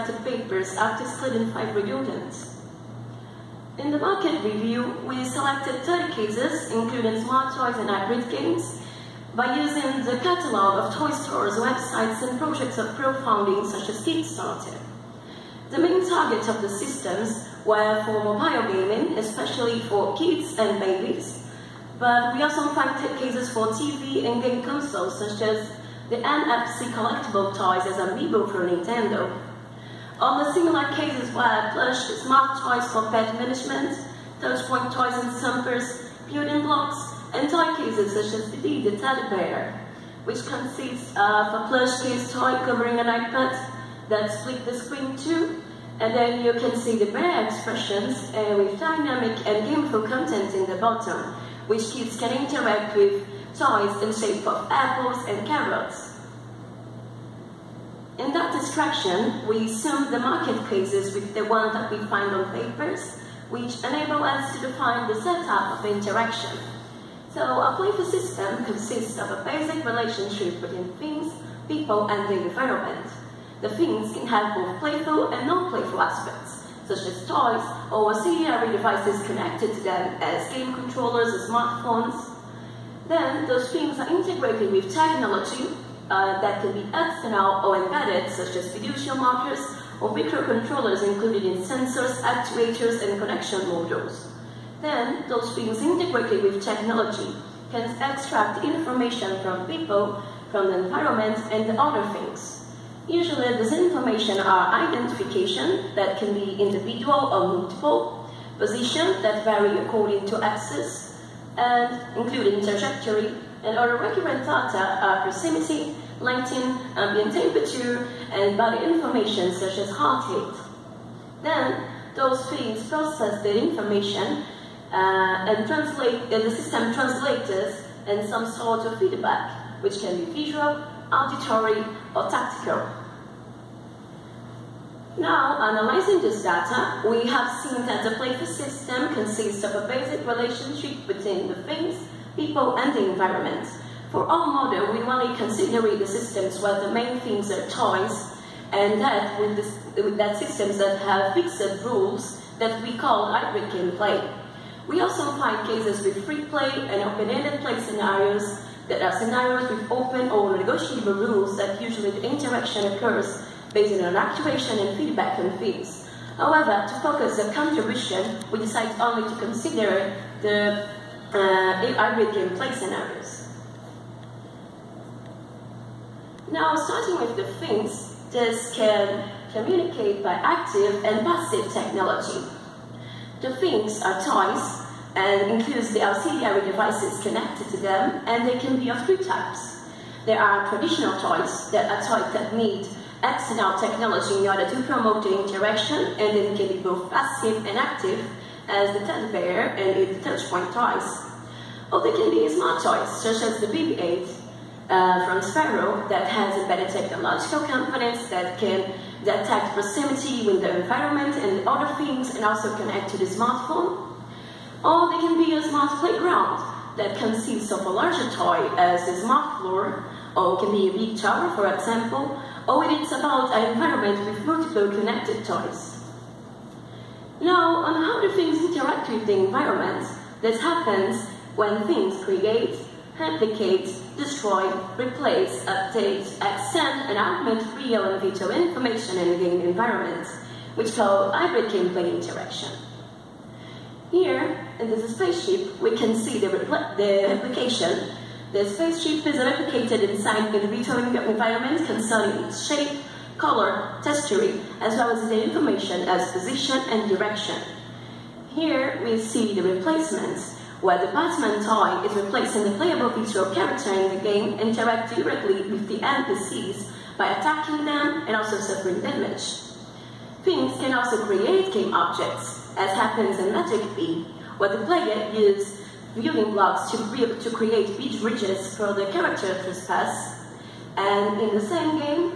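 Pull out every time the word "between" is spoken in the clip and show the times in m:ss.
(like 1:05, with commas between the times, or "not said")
1:10, 2:21.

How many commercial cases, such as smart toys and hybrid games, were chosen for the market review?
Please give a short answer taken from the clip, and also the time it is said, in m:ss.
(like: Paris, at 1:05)
30, at 0:05.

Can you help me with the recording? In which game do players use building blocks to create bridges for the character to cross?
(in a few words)
Magic Bee.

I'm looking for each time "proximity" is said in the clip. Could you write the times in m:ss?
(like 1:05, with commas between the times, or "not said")
1:55, 3:29.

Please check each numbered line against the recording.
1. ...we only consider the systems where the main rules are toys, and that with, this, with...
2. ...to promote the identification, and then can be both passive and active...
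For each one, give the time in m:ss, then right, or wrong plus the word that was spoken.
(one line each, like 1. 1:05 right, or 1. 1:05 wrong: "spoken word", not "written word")
1. 2:24 wrong: "themes", not "rules"
2. 3:14 wrong: "interaction", not "identification".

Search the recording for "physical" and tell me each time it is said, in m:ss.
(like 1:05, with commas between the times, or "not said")
not said.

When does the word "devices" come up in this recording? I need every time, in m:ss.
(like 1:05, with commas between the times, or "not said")
1:18, 3:06.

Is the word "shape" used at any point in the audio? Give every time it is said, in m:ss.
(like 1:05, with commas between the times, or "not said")
0:54, 4:12.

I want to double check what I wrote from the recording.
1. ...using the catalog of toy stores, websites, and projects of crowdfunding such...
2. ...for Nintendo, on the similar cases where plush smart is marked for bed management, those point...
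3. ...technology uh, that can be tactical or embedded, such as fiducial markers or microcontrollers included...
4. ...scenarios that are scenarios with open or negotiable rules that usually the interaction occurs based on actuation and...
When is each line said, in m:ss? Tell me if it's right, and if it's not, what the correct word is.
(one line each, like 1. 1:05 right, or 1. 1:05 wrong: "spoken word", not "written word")
1. 0:09 right
2. 0:28 right
3. 1:24 wrong: "external", not "tactical"
4. 2:37 right.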